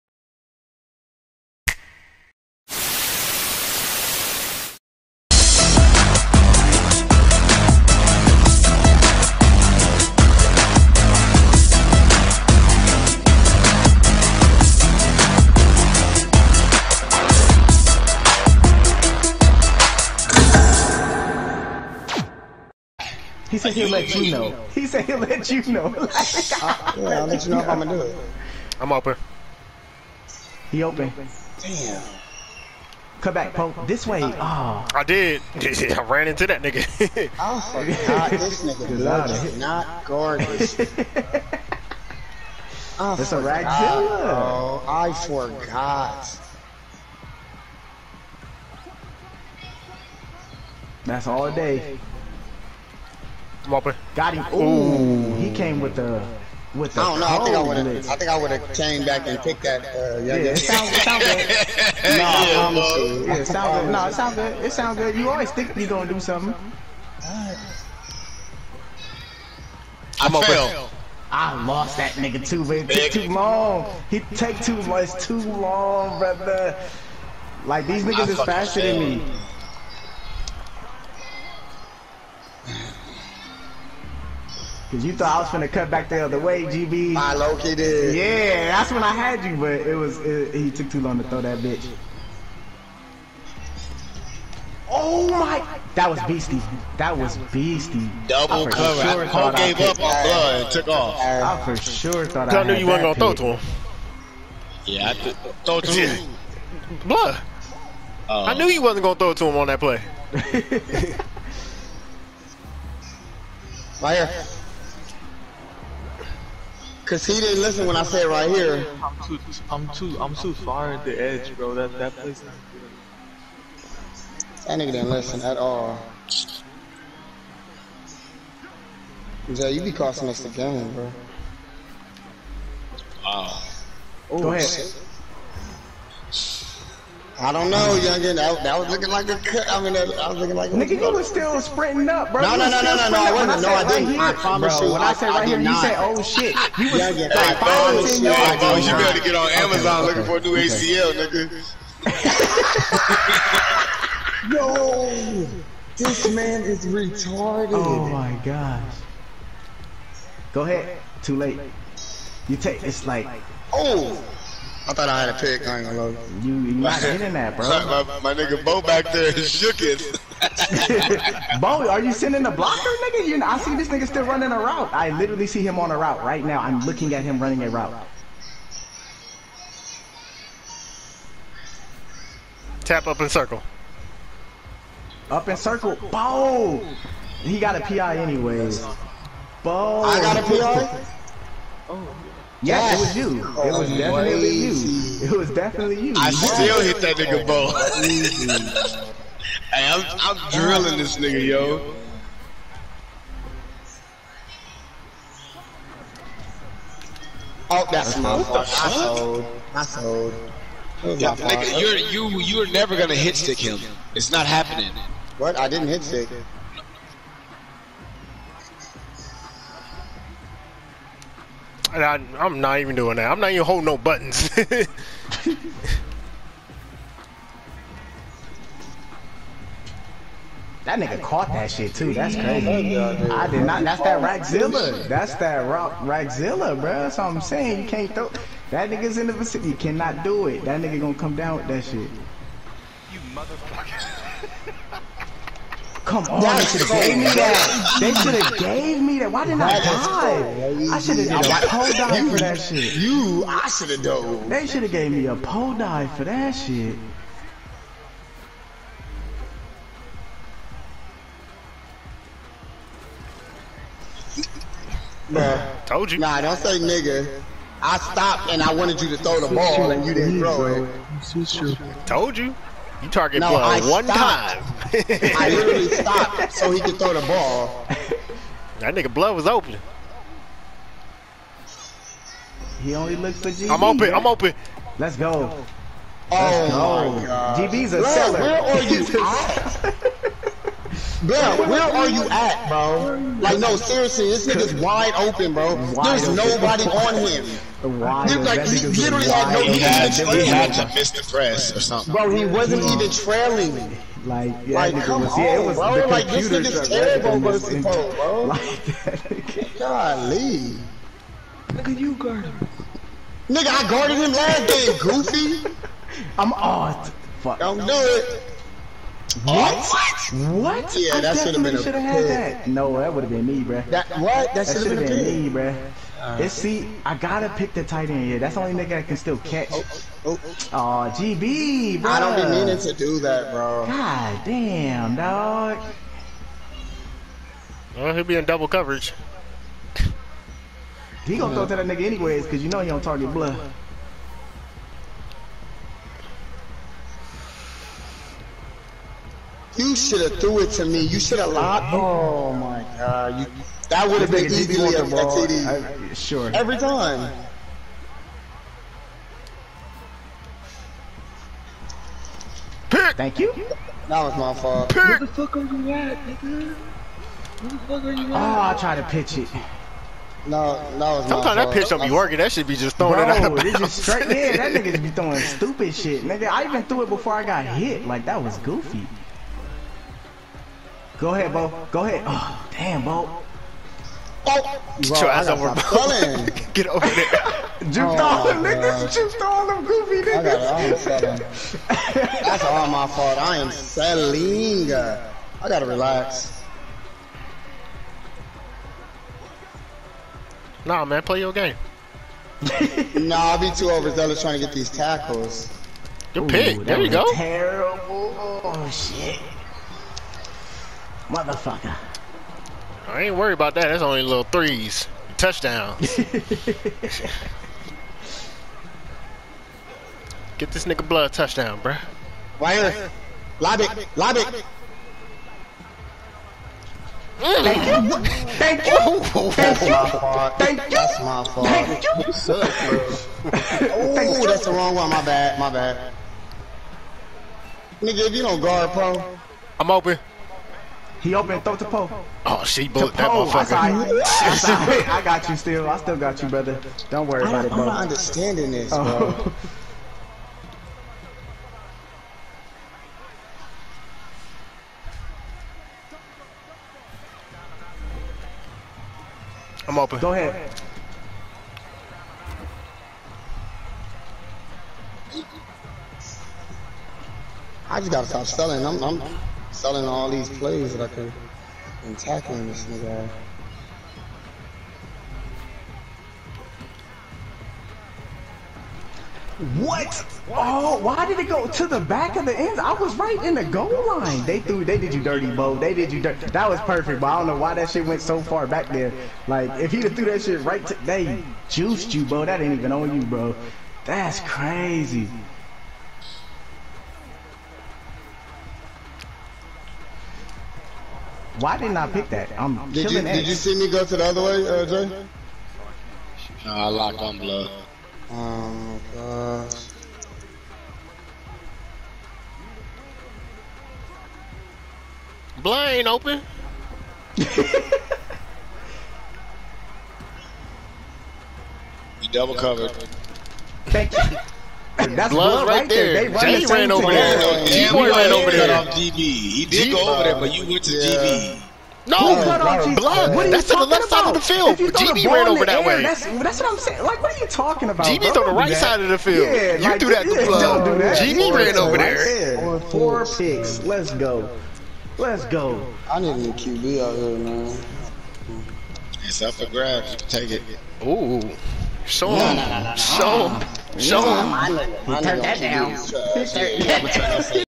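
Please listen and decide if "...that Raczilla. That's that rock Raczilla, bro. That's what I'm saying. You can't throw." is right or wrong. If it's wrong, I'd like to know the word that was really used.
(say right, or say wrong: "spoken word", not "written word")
right.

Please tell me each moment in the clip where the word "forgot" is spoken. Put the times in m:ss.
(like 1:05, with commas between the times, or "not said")
0:45.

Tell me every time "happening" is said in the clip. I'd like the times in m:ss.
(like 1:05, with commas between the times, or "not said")
3:34.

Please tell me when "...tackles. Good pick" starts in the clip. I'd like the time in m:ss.
6:44.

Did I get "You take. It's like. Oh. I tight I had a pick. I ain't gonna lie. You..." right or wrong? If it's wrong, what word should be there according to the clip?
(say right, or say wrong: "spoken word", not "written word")
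wrong: "thought", not "tight".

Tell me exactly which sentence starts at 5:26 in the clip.
Uh, it's see, I gotta pick the tight end.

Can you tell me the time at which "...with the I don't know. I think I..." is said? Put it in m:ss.
0:56.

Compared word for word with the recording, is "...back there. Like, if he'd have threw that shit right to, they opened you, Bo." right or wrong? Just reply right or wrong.
wrong.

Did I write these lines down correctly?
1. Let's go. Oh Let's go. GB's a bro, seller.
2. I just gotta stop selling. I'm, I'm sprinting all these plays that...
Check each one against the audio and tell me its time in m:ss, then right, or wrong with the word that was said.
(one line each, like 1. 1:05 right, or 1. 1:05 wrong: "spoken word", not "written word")
1. 4:44 right
2. 7:47 wrong: "selling", not "sprinting".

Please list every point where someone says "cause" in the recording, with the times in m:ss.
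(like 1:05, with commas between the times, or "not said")
1:24, 1:57, 5:42.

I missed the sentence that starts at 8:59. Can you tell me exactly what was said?
Yeah, you like, threw that to blood.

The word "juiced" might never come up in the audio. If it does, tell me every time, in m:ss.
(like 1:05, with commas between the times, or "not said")
8:11.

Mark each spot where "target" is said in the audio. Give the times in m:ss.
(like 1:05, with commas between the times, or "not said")
4:33, 5:43.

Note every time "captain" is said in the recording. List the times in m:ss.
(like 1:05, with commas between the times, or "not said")
not said.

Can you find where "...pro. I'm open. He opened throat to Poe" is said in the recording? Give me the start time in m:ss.
7:18.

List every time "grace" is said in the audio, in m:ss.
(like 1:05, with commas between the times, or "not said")
not said.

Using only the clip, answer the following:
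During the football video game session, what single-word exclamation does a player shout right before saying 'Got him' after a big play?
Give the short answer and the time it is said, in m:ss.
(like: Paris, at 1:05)
Whopper, at 0:53.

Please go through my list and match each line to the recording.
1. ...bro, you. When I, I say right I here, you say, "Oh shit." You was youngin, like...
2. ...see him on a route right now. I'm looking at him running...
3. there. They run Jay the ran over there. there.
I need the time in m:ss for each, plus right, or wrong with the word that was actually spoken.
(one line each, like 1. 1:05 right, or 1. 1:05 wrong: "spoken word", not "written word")
1. 2:24 right
2. 2:55 right
3. 8:46 right.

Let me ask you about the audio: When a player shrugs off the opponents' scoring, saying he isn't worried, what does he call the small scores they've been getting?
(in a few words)
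little threes.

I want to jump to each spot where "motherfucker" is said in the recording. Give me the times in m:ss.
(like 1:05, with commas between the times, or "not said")
4:03, 6:51, 7:23.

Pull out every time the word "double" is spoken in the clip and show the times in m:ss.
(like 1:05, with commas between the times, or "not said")
1:38, 5:38, 8:42.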